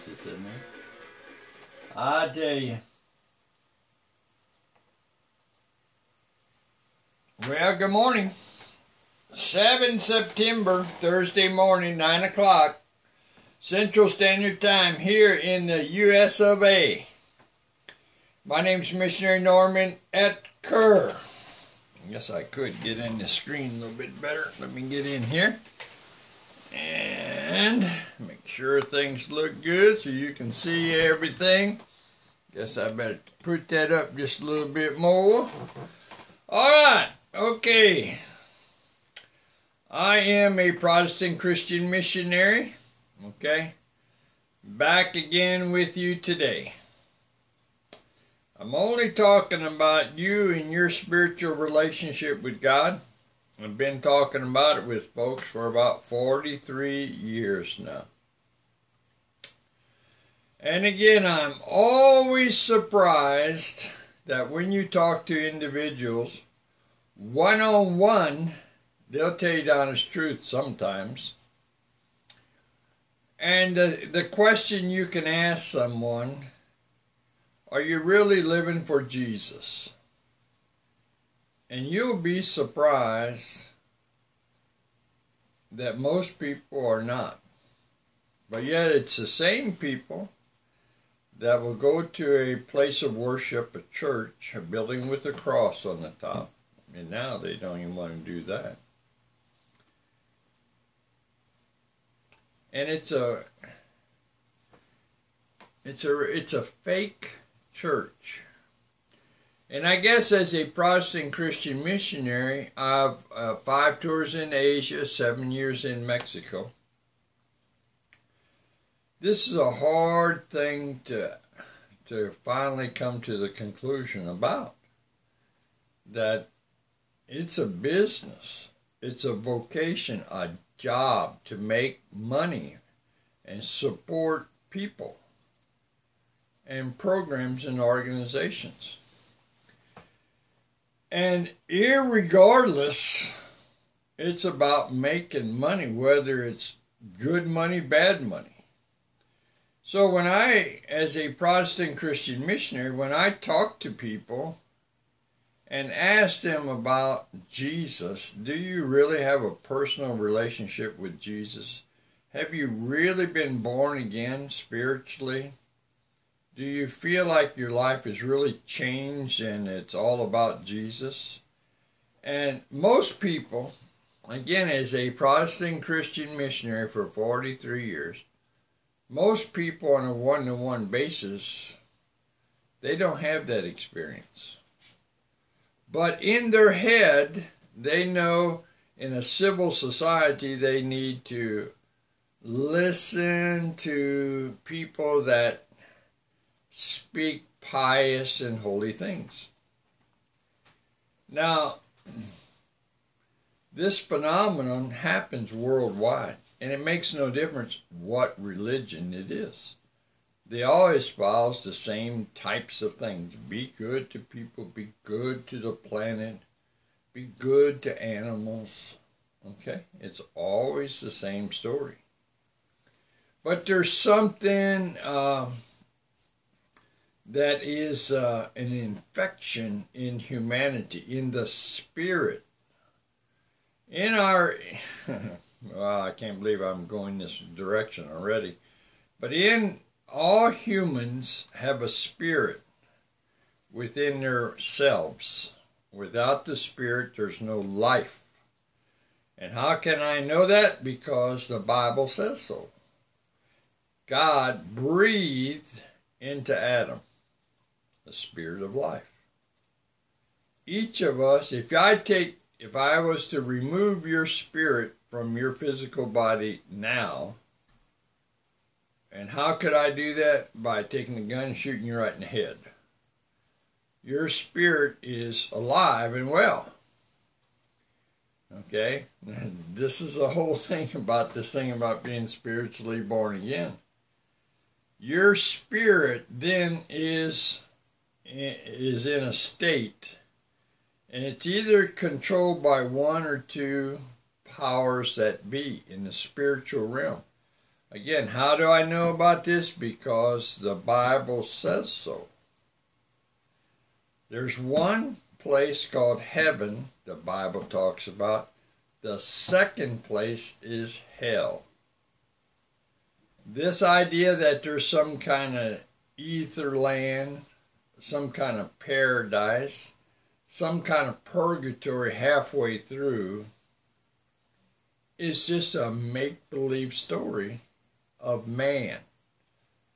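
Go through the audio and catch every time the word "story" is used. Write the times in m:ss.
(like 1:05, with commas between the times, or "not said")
3:41, 5:26.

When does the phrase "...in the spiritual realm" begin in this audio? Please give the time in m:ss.
4:55.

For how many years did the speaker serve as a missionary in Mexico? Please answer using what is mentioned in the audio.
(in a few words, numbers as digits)
7.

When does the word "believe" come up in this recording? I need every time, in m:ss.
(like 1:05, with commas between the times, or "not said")
3:56, 5:26.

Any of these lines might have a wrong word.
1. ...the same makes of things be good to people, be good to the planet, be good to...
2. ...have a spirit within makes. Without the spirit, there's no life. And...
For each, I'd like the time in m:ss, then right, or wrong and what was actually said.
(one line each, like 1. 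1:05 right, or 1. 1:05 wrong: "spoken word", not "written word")
1. 3:31 wrong: "types", not "makes"
2. 4:01 wrong: "themselves", not "makes".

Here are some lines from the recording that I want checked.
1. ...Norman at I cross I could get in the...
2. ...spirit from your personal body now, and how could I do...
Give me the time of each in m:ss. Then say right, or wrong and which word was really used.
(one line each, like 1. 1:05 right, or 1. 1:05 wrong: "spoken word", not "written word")
1. 0:19 wrong: "guess", not "cross"
2. 4:24 wrong: "physical", not "personal".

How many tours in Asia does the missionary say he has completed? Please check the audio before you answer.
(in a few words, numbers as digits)
5.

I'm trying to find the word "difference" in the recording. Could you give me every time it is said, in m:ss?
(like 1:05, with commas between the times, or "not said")
3:27.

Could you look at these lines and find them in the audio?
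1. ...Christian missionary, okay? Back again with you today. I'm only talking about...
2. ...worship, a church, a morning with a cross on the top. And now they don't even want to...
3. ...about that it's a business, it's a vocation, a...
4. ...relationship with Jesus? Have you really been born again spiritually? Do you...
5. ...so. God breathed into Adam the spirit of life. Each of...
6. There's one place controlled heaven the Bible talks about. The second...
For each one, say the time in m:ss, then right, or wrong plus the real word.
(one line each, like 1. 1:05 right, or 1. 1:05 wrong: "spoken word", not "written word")
1. 0:41 right
2. 1:33 wrong: "building", not "morning"
3. 2:04 right
4. 2:40 right
5. 4:12 right
6. 5:04 wrong: "called", not "controlled".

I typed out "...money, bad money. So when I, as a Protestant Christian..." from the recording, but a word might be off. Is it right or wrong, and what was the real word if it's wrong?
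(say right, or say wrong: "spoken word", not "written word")
right.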